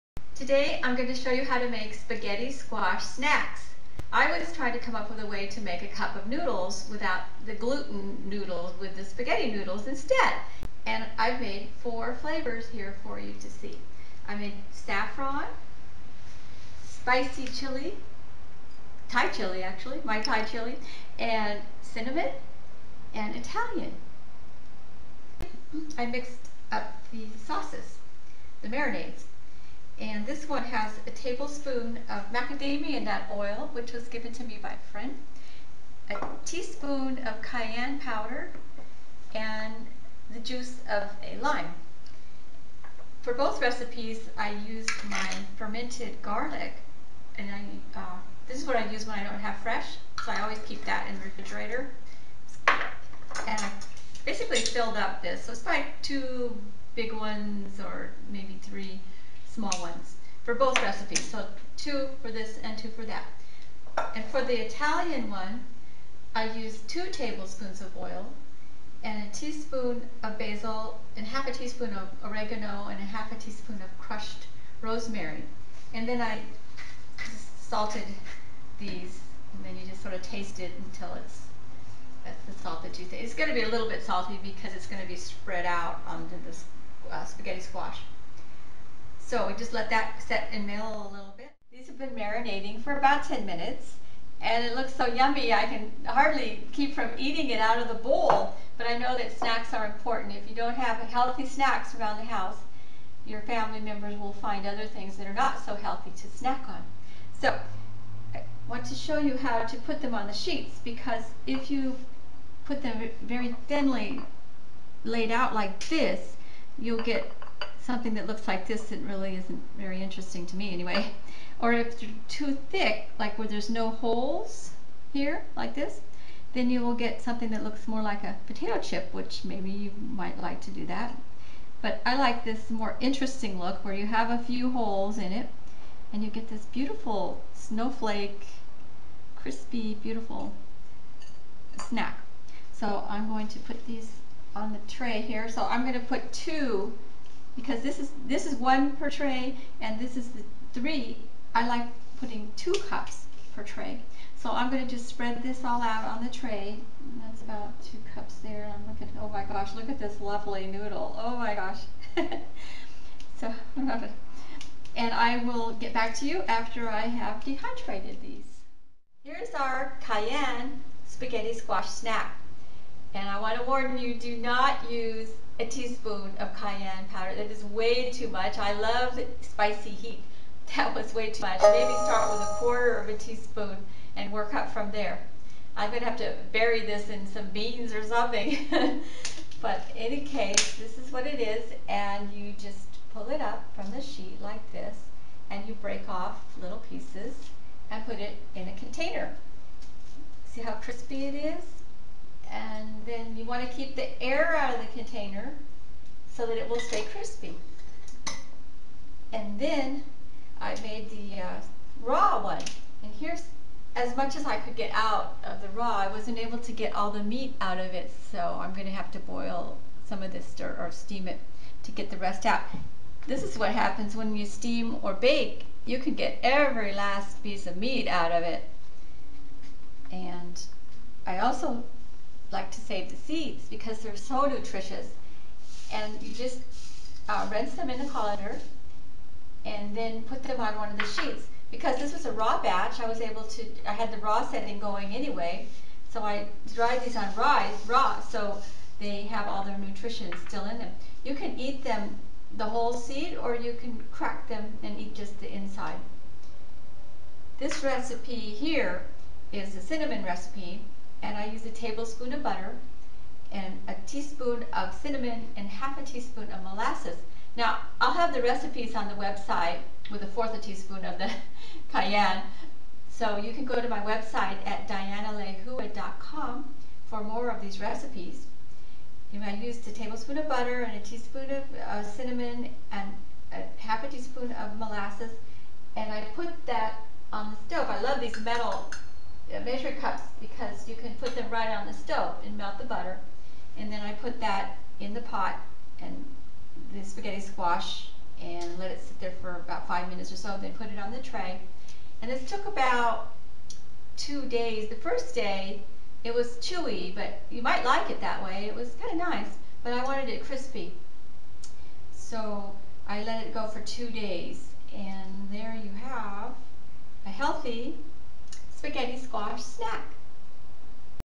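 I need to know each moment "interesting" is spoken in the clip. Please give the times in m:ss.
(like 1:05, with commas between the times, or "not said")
2:00, 2:12.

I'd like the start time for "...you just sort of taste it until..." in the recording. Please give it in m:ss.
1:19.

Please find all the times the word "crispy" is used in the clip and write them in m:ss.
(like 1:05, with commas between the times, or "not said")
2:19, 3:20, 3:27, 5:10.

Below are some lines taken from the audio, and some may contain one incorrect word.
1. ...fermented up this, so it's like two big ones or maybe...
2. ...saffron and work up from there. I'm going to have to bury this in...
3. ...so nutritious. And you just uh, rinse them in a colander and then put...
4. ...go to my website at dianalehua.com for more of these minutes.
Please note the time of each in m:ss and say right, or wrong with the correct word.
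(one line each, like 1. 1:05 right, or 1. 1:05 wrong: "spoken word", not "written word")
1. 0:54 wrong: "filled", not "fermented"
2. 3:03 wrong: "teaspoon", not "saffron"
3. 3:54 right
4. 4:33 wrong: "recipes", not "minutes".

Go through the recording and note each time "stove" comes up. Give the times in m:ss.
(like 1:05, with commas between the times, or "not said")
4:47, 4:51.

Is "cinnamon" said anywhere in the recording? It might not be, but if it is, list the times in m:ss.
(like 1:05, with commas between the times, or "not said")
0:21, 4:19, 4:24, 4:42.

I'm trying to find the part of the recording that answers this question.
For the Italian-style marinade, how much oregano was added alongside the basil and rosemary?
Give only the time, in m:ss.
1:11.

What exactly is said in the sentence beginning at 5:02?
And this took about two days.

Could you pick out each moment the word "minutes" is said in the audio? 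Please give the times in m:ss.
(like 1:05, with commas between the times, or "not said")
1:33, 5:00.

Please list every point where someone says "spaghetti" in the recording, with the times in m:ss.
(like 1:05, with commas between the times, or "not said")
0:01, 0:09, 1:27, 2:51, 4:57, 5:18.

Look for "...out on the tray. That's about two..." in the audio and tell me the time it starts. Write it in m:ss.
2:35.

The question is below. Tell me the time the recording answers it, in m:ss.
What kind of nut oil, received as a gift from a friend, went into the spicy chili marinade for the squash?
0:32.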